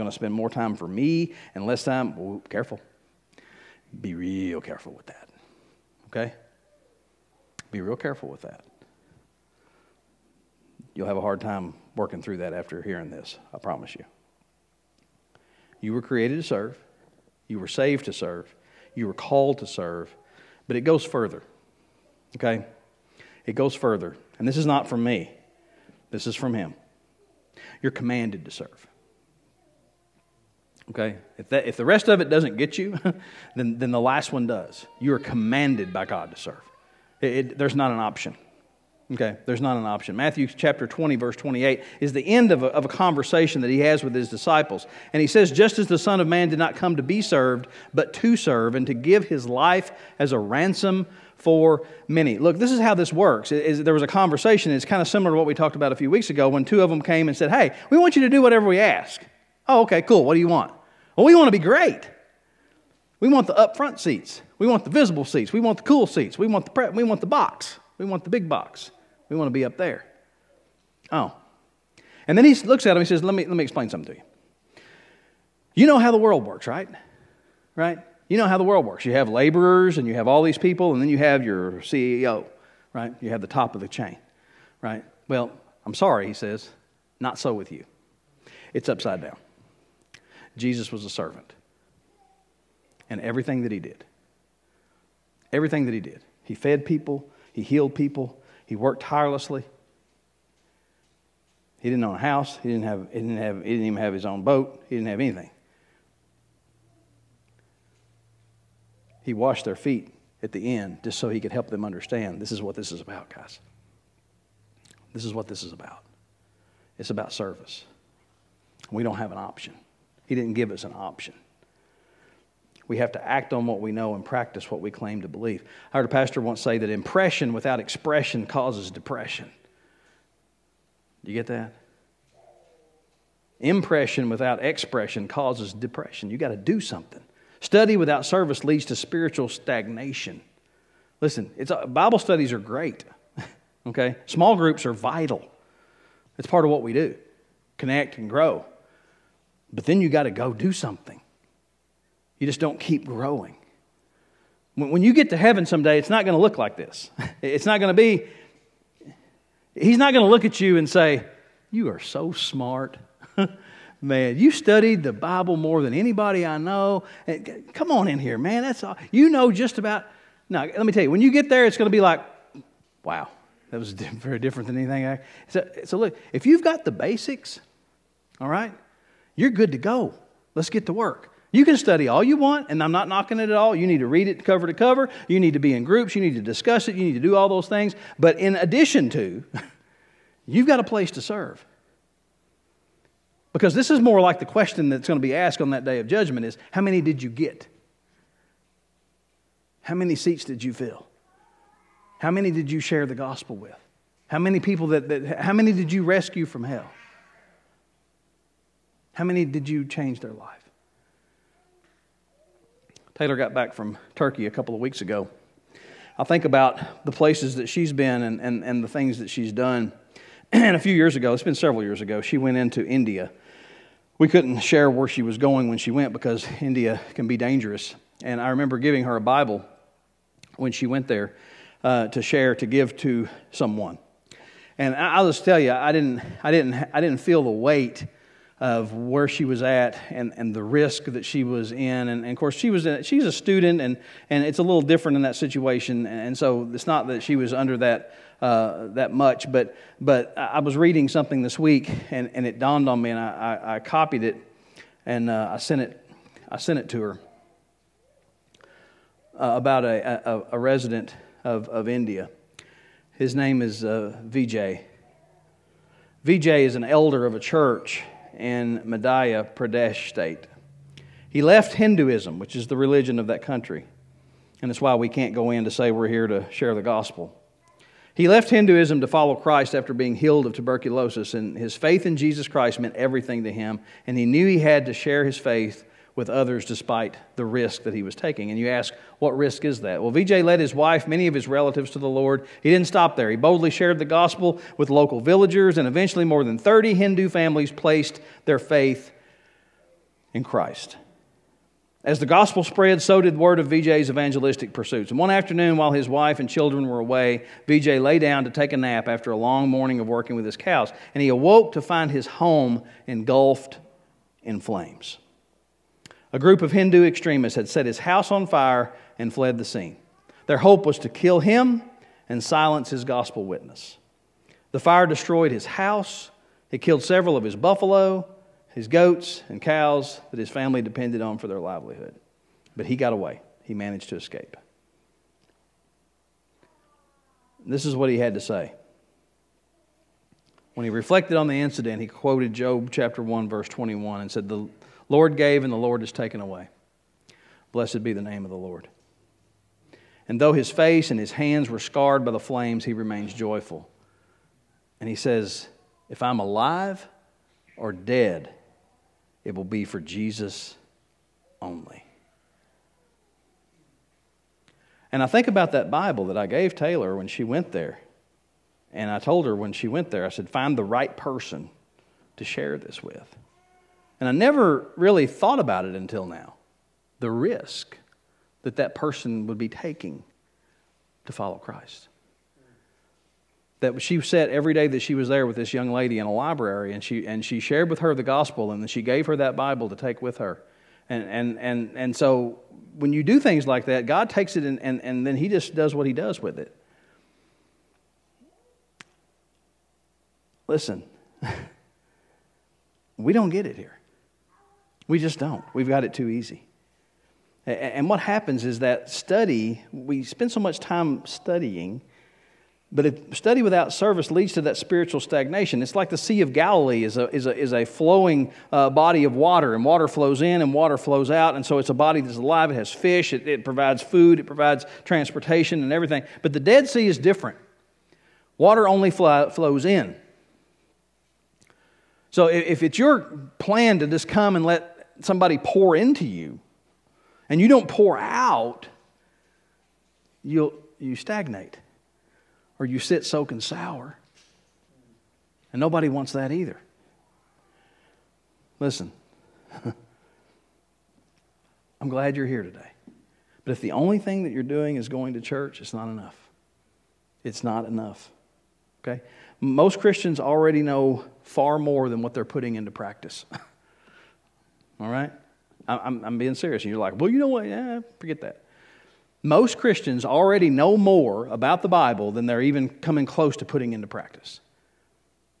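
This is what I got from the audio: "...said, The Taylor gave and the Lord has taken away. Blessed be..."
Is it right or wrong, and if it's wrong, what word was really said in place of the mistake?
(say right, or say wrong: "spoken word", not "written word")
wrong: "Lord", not "Taylor".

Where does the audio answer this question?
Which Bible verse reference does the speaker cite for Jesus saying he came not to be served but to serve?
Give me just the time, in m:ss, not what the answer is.
0:40.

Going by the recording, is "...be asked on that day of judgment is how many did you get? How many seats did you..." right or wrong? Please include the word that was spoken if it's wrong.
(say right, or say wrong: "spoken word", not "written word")
right.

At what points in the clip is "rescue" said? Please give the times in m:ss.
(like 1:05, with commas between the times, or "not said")
3:26.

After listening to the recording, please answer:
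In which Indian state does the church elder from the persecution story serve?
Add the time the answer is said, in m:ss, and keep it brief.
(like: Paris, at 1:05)
Madhya Pradesh, at 4:28.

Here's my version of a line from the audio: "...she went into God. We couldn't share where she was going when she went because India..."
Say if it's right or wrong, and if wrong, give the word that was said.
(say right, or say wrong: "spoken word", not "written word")
wrong: "India", not "God".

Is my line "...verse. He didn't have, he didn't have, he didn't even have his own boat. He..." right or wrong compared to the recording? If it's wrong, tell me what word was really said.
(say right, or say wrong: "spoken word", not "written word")
wrong: "house", not "verse".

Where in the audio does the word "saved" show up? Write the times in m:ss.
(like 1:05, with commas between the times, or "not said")
0:17.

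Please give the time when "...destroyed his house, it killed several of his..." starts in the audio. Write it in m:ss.
5:25.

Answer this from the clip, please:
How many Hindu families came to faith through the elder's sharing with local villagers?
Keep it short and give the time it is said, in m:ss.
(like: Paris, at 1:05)
more than 30, at 4:56.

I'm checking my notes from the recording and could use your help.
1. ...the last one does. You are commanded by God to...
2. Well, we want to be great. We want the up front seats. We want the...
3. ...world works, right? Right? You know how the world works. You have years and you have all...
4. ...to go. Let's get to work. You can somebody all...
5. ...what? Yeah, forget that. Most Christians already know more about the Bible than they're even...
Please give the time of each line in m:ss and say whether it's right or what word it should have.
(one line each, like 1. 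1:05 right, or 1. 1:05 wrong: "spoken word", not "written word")
1. 0:33 right
2. 1:01 right
3. 1:16 wrong: "laborers", not "years"
4. 2:59 wrong: "study", not "somebody"
5. 7:47 right.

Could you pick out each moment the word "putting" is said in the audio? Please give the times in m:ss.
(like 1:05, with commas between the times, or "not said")
7:42, 7:53.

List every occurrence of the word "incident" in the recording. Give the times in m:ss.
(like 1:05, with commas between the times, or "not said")
5:41.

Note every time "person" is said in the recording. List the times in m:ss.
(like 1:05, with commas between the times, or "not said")
6:11, 6:18.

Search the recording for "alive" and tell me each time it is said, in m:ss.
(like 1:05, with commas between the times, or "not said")
5:56, 7:02.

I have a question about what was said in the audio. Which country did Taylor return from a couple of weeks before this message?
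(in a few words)
Turkey.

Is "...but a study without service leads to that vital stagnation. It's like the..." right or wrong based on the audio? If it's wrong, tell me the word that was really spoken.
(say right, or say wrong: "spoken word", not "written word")
wrong: "spiritual", not "vital".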